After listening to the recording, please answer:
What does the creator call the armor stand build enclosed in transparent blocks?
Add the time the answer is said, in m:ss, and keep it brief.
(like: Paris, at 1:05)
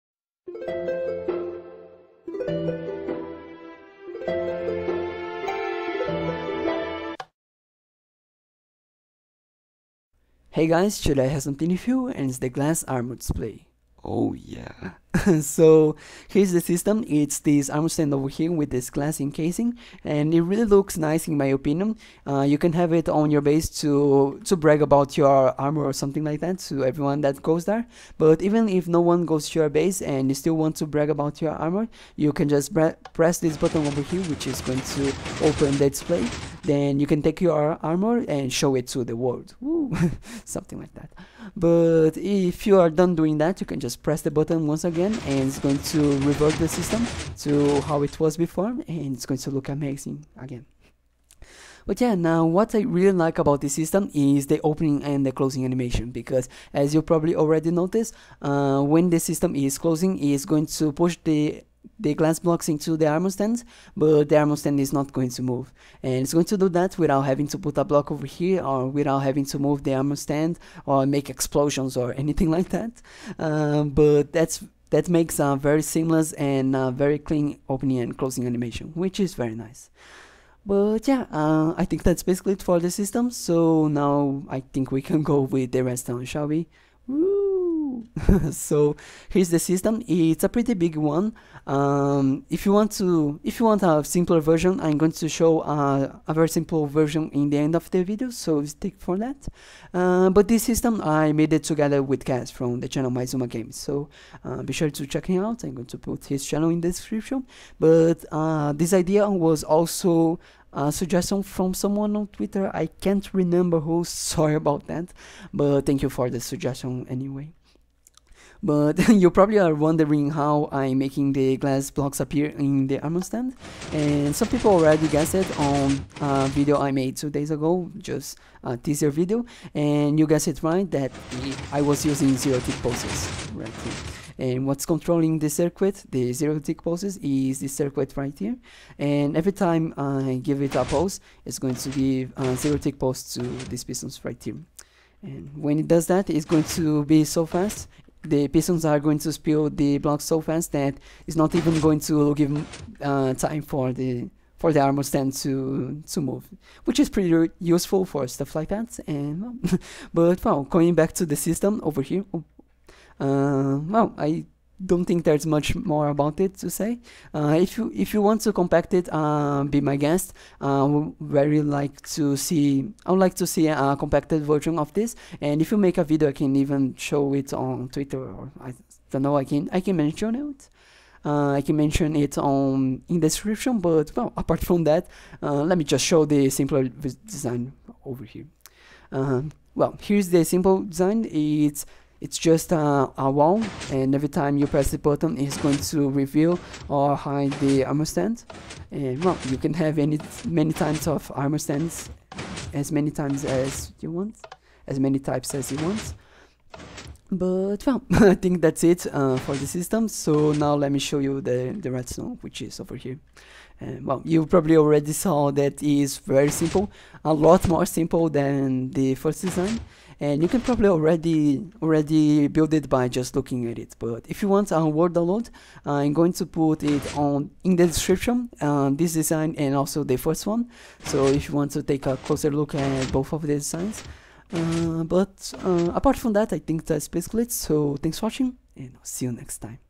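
glass armor display, at 0:12.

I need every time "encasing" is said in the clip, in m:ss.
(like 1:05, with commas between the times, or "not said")
0:19.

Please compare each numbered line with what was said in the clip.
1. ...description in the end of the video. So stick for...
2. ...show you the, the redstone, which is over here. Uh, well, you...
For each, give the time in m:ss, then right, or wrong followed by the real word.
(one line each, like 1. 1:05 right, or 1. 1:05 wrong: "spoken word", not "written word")
1. 1:36 wrong: "version", not "description"
2. 3:30 right.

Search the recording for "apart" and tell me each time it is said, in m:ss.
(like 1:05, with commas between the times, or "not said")
3:04, 3:55.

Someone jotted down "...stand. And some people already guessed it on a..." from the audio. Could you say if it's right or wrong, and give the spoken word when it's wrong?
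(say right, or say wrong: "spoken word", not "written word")
right.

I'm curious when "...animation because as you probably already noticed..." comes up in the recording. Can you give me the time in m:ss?
0:55.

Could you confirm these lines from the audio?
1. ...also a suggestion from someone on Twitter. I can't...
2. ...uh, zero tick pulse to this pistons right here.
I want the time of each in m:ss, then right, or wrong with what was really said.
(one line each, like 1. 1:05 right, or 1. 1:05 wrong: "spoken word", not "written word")
1. 1:49 right
2. 2:22 right.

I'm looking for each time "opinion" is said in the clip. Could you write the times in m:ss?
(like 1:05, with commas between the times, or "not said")
0:21.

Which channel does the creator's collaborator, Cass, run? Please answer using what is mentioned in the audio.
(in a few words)
Maizuma Games.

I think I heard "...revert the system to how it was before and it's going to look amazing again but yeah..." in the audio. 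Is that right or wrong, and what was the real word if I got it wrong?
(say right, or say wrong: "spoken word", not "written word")
right.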